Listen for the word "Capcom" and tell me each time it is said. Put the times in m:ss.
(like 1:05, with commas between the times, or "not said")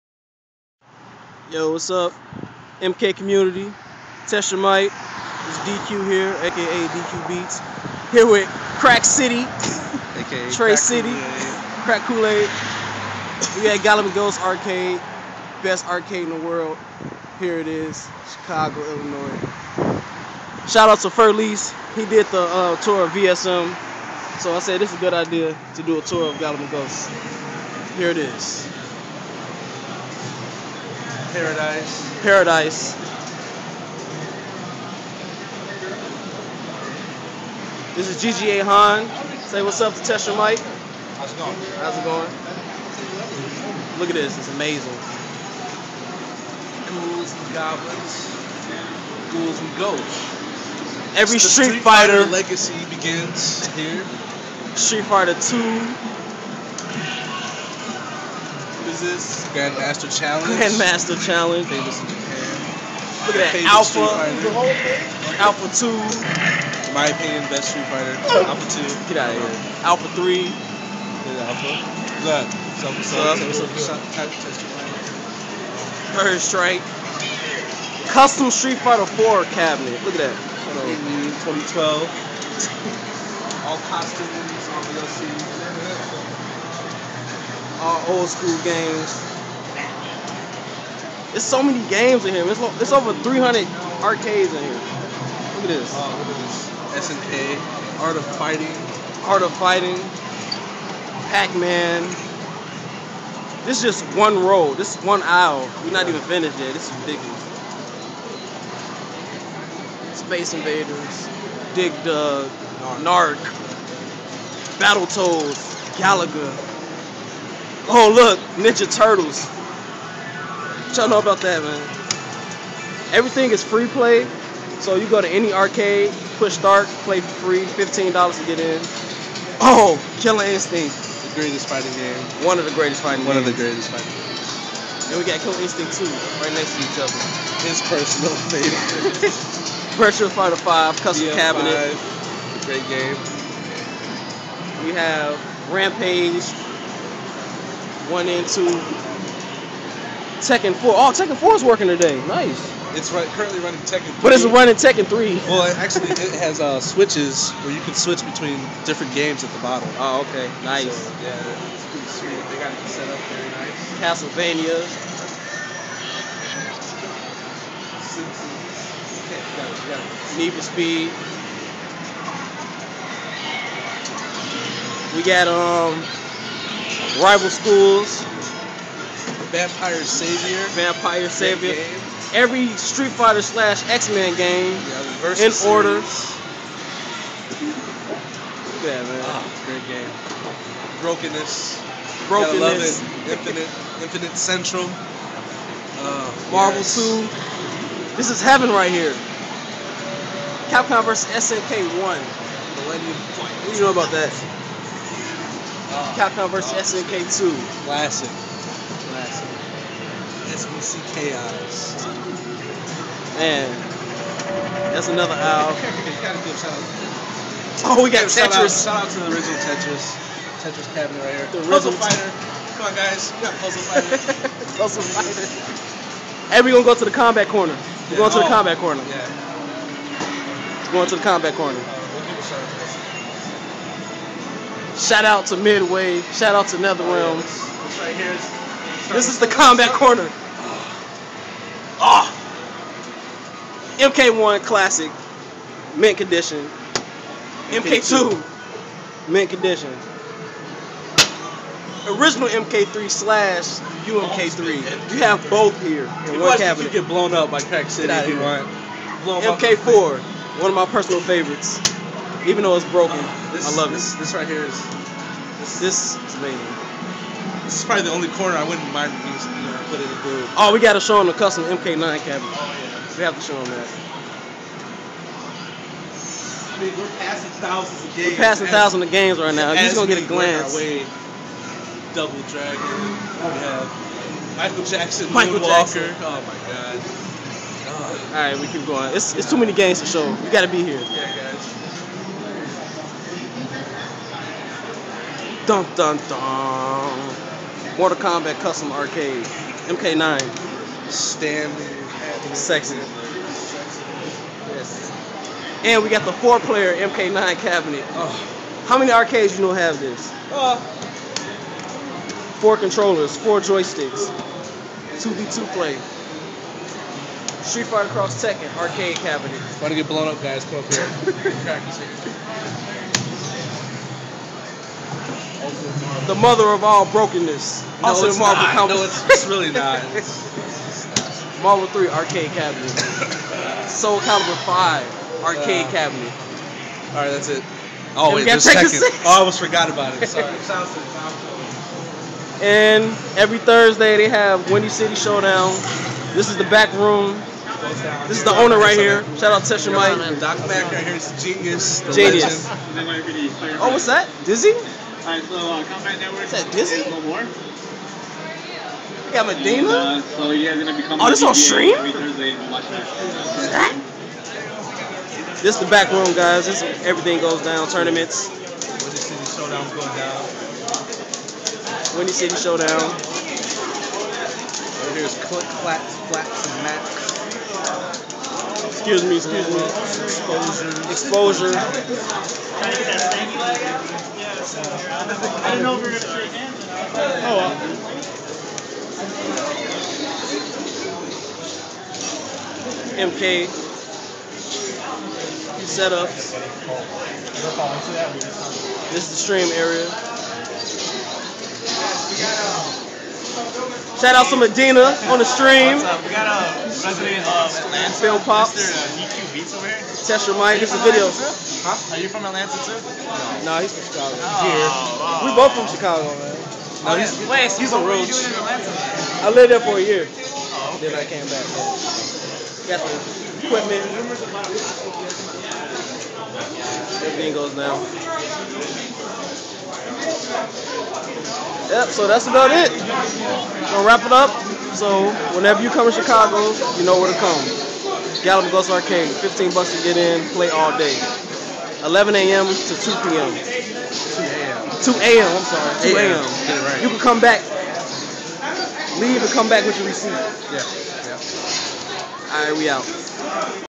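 3:20, 3:26.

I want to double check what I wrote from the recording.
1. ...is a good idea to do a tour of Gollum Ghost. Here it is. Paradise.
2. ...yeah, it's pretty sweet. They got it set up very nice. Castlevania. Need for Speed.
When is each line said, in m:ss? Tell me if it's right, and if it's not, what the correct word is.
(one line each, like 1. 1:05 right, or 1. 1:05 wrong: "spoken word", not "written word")
1. 0:24 right
2. 2:41 right.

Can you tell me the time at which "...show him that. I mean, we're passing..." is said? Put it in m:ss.
4:33.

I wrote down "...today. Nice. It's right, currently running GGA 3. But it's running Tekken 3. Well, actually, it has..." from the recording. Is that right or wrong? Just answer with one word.
wrong.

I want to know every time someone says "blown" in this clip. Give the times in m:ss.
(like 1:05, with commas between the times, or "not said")
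4:17, 5:20.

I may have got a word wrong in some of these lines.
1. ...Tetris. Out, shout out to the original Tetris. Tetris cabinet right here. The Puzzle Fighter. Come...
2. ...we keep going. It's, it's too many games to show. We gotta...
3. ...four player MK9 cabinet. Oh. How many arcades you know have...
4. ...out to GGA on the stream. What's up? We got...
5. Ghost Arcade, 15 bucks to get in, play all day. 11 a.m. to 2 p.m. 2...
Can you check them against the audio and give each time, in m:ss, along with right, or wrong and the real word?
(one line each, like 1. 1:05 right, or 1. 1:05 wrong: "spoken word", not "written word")
1. 3:38 right
2. 4:48 right
3. 5:06 right
4. 6:44 wrong: "Medina", not "GGA"
5. 7:18 right.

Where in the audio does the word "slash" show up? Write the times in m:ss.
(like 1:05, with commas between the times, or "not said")
3:03, 4:13.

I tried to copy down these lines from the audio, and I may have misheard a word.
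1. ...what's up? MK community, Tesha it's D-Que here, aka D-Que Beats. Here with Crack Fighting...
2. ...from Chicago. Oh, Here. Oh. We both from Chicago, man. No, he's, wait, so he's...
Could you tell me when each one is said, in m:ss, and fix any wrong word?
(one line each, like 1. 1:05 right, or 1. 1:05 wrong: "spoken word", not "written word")
1. 0:01 wrong: "City", not "Fighting"
2. 6:53 right.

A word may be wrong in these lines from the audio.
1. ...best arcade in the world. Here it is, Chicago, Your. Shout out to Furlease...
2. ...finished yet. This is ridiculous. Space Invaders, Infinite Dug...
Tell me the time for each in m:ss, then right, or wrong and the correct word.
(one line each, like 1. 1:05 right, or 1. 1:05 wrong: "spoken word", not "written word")
1. 0:15 wrong: "Illinois", not "Your"
2. 1:46 wrong: "Dig", not "Infinite".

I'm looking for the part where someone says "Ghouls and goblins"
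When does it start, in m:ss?
0:46.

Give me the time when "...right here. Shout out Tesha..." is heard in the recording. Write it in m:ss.
5:48.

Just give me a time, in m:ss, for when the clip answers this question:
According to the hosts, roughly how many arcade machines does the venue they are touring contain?
1:32.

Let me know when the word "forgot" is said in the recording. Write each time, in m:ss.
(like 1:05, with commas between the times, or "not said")
5:39.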